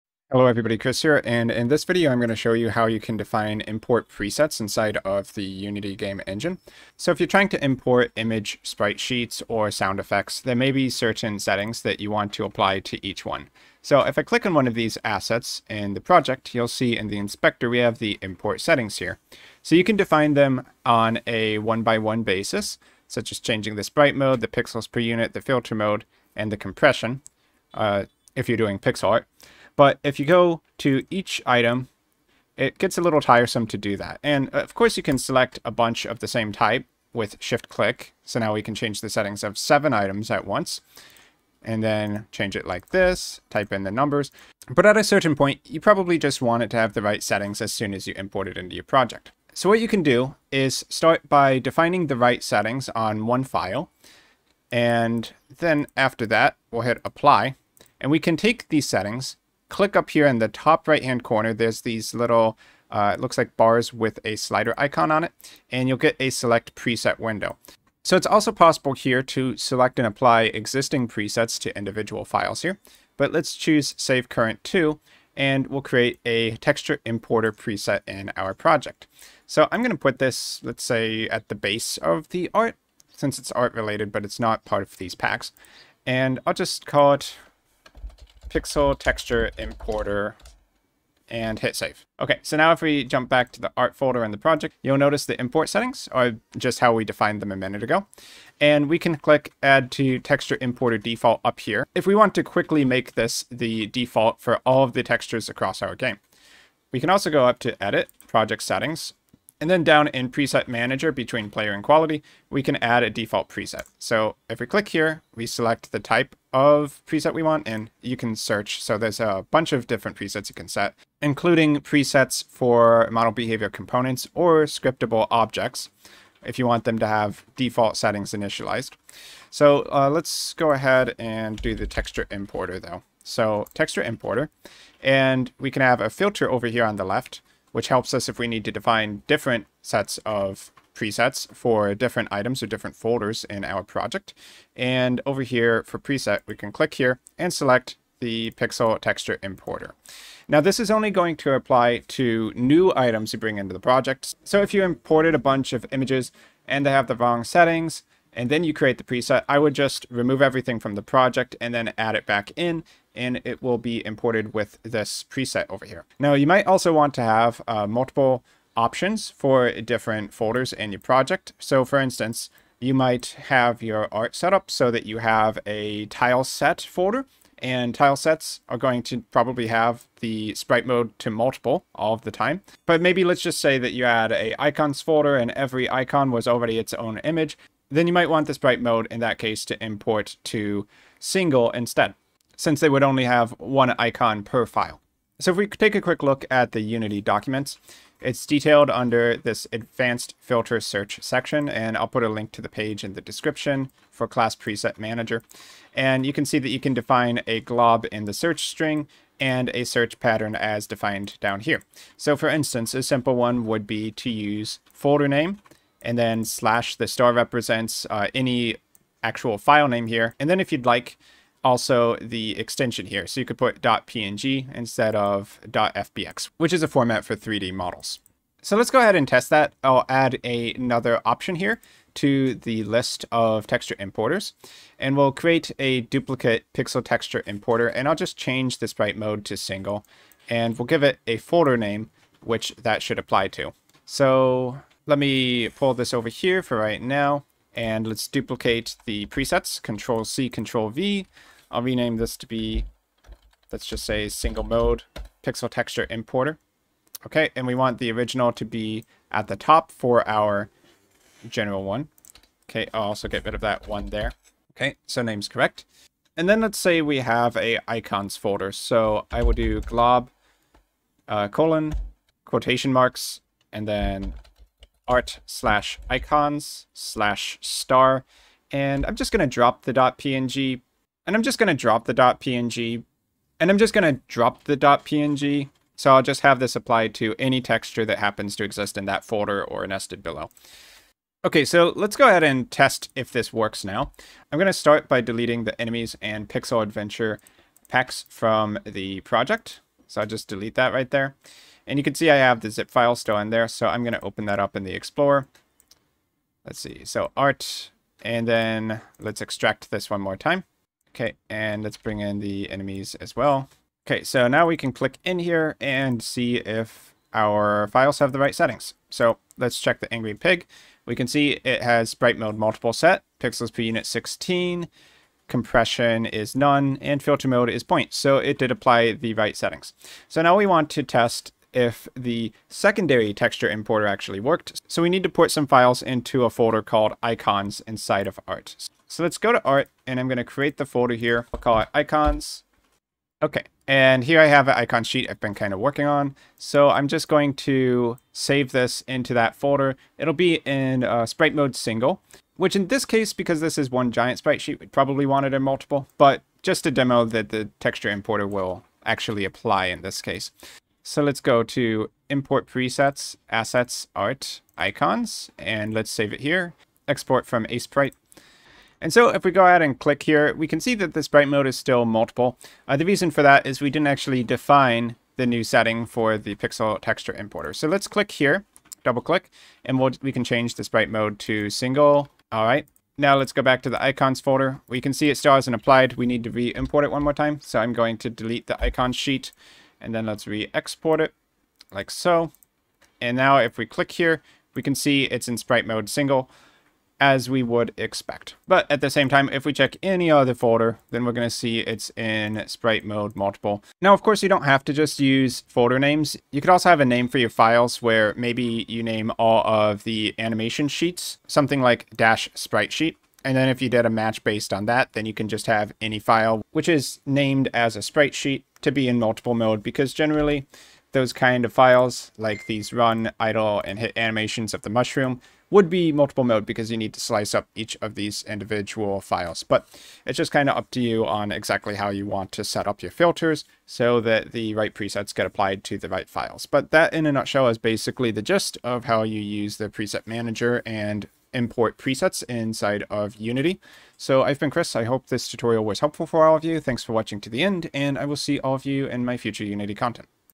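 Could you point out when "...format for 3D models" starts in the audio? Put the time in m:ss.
3:46.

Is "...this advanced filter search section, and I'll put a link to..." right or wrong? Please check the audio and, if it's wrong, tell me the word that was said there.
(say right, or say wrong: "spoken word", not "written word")
right.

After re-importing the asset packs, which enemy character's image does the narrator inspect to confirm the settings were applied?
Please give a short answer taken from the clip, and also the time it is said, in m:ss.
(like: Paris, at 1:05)
Angry Pig, at 5:20.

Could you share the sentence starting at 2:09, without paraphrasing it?
So uh, let's go ahead and do the texture importer though.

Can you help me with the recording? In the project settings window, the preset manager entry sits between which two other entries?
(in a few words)
Player and Quality.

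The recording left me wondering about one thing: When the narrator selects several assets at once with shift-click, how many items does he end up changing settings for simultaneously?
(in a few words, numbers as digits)
7.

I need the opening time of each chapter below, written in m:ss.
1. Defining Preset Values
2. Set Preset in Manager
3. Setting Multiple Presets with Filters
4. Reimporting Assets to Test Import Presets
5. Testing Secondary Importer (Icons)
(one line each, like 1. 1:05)
1. 0:49
2. 1:32
3. 2:46
4. 3:48
5. 5:34.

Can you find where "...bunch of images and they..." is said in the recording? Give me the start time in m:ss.
2:35.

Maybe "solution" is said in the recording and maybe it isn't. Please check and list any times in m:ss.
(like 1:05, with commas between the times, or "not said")
not said.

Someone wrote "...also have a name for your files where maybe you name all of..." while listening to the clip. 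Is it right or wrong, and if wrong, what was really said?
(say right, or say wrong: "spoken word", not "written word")
right.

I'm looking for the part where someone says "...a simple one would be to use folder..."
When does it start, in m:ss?
3:32.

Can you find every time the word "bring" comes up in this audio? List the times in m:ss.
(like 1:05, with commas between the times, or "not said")
2:33, 5:11.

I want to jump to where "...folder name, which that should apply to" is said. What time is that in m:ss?
4:01.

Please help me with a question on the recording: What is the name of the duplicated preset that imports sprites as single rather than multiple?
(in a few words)
Single Mode Pixel Texture Importer.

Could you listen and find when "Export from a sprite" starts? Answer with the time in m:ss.
6:07.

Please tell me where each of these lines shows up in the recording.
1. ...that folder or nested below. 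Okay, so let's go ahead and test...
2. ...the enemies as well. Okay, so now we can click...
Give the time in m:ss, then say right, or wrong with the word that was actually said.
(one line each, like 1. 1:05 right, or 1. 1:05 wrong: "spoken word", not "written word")
1. 4:49 right
2. 5:12 right.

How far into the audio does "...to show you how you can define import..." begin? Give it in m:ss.
0:02.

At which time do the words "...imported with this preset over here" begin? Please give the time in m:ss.
2:44.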